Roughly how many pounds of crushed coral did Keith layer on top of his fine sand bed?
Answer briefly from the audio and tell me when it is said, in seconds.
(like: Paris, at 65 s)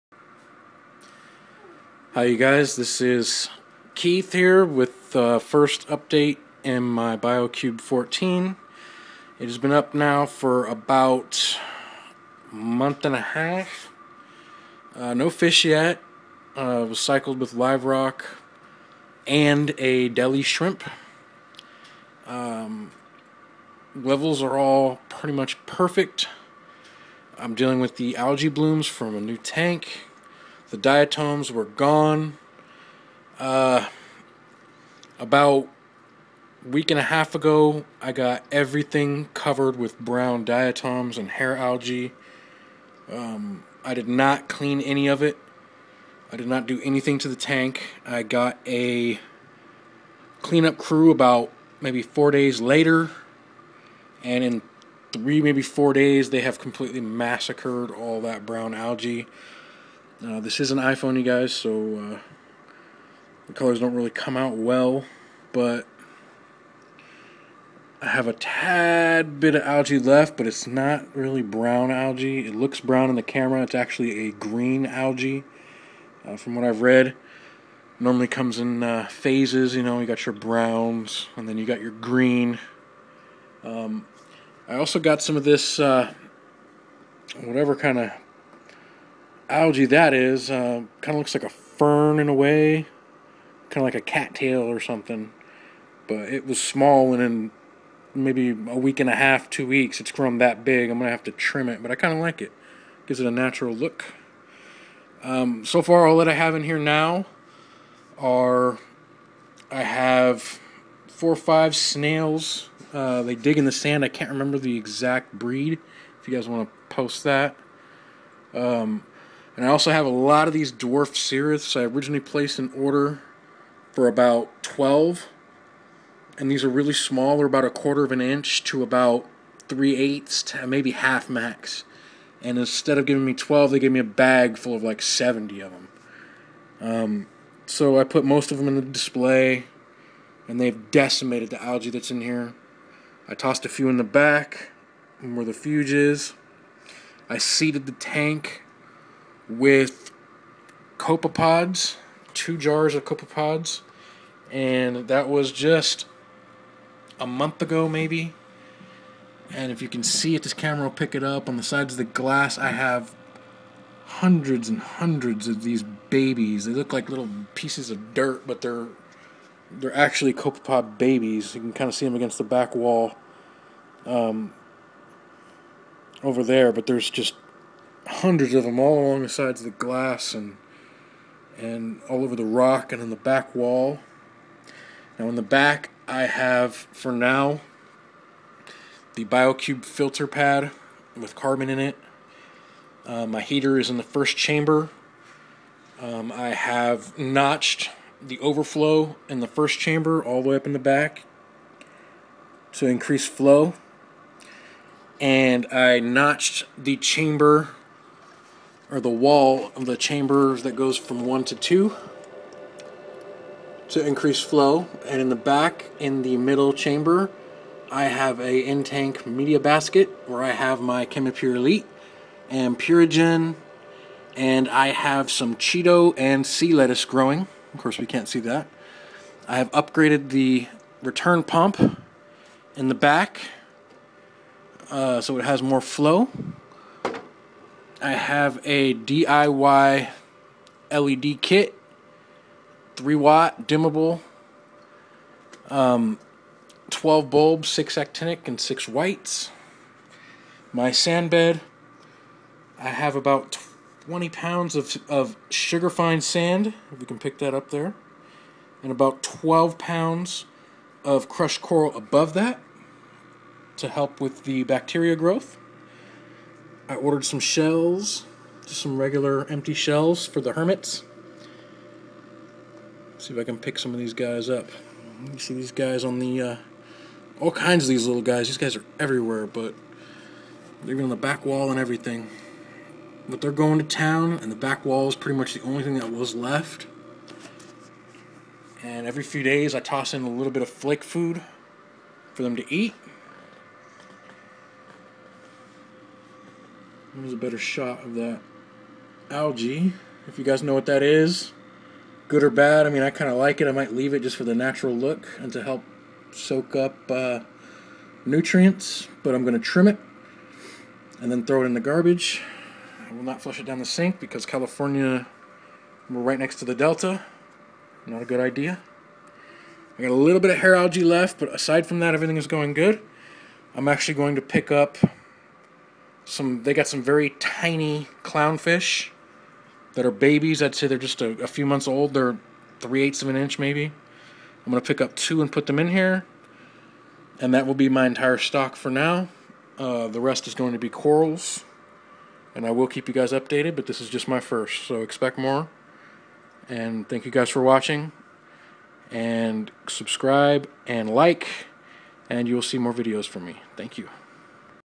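12 pounds, at 259 s.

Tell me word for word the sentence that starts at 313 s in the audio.
I will not flush it down the sink because California, we're right next to the Delta.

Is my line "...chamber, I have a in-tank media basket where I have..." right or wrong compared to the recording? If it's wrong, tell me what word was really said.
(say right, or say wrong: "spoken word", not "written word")
right.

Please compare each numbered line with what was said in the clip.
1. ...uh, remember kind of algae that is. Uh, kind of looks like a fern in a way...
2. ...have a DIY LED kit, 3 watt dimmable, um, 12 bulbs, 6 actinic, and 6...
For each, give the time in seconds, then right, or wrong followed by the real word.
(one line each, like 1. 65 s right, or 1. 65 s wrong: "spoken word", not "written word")
1. 85 s wrong: "whatever", not "remember"
2. 238 s right.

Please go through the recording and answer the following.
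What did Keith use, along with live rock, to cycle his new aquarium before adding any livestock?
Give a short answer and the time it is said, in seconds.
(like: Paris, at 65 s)
A deli shrimp, at 19 s.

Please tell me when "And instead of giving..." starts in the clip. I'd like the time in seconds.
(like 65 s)
132 s.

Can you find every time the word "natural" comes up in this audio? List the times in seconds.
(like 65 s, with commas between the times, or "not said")
103 s, 304 s.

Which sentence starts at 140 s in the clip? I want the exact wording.
And they've decimated the algae that's in here.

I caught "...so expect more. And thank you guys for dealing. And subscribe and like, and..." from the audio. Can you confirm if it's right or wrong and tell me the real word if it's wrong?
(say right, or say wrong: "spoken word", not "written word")
wrong: "watching", not "dealing".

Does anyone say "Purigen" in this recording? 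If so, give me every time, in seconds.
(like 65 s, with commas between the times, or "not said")
222 s.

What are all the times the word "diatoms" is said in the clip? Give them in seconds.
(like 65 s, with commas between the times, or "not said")
30 s, 40 s.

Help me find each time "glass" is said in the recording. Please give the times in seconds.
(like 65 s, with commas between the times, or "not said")
162 s, 179 s.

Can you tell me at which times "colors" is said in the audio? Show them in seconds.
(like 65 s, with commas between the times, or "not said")
63 s.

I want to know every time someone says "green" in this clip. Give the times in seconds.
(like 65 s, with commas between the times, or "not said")
74 s, 81 s.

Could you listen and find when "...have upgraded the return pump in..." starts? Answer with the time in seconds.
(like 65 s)
229 s.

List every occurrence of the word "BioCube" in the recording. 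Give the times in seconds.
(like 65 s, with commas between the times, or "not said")
7 s, 189 s.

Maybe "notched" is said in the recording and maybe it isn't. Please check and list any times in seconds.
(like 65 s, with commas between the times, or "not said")
197 s, 205 s.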